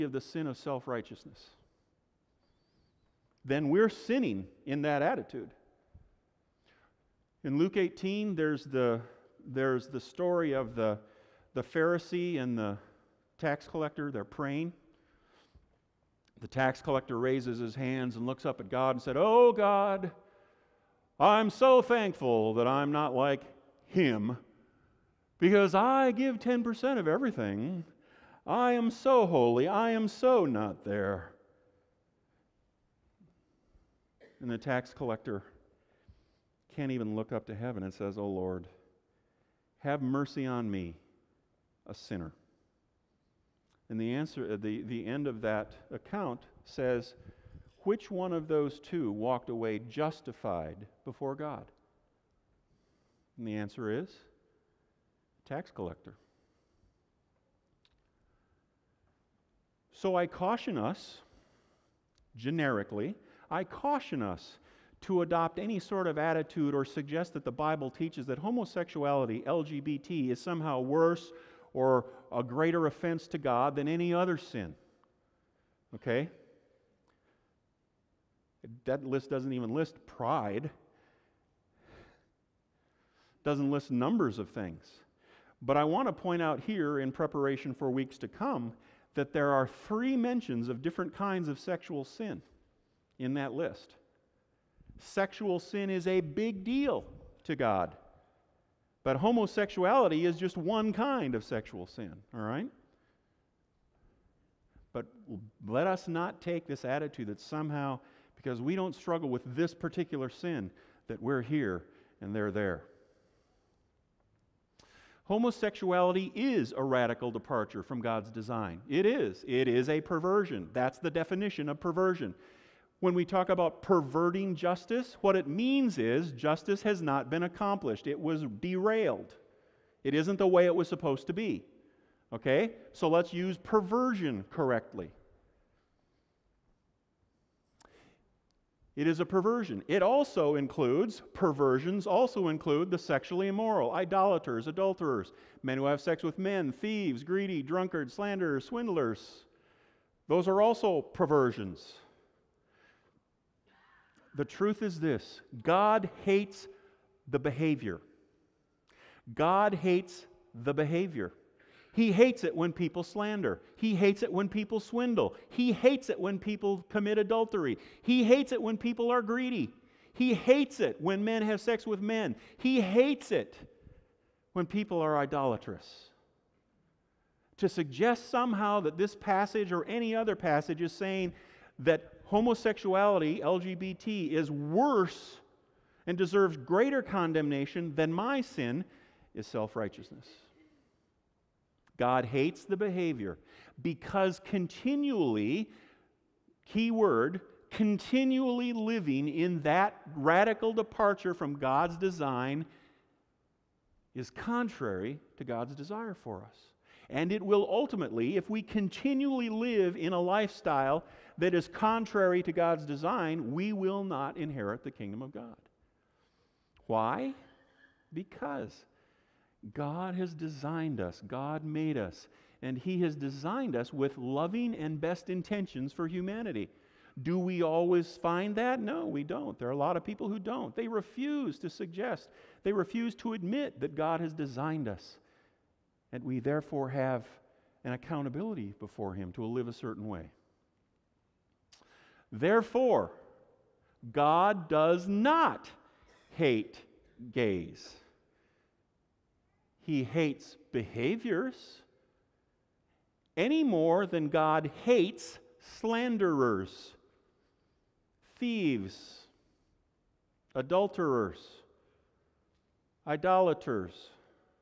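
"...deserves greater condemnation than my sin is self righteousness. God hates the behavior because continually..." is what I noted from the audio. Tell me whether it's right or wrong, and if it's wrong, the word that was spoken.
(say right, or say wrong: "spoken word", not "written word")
right.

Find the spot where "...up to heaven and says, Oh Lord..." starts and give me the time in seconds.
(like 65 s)
37 s.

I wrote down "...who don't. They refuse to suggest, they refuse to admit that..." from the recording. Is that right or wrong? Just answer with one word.
right.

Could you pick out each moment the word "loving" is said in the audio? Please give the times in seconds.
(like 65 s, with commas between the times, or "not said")
224 s.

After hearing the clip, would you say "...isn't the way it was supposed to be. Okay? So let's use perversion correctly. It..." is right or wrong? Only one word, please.
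right.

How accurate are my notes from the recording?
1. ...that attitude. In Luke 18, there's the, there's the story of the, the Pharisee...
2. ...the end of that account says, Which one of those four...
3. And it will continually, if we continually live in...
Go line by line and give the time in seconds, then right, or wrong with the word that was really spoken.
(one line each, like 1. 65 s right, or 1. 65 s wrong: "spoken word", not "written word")
1. 4 s right
2. 44 s wrong: "two", not "four"
3. 207 s wrong: "ultimately", not "continually".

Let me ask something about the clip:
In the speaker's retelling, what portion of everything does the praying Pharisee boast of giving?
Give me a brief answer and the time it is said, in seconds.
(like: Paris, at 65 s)
10%, at 26 s.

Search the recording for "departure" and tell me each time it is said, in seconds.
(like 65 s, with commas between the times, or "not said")
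117 s, 200 s.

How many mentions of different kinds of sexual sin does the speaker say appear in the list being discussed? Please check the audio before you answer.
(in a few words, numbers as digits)
3.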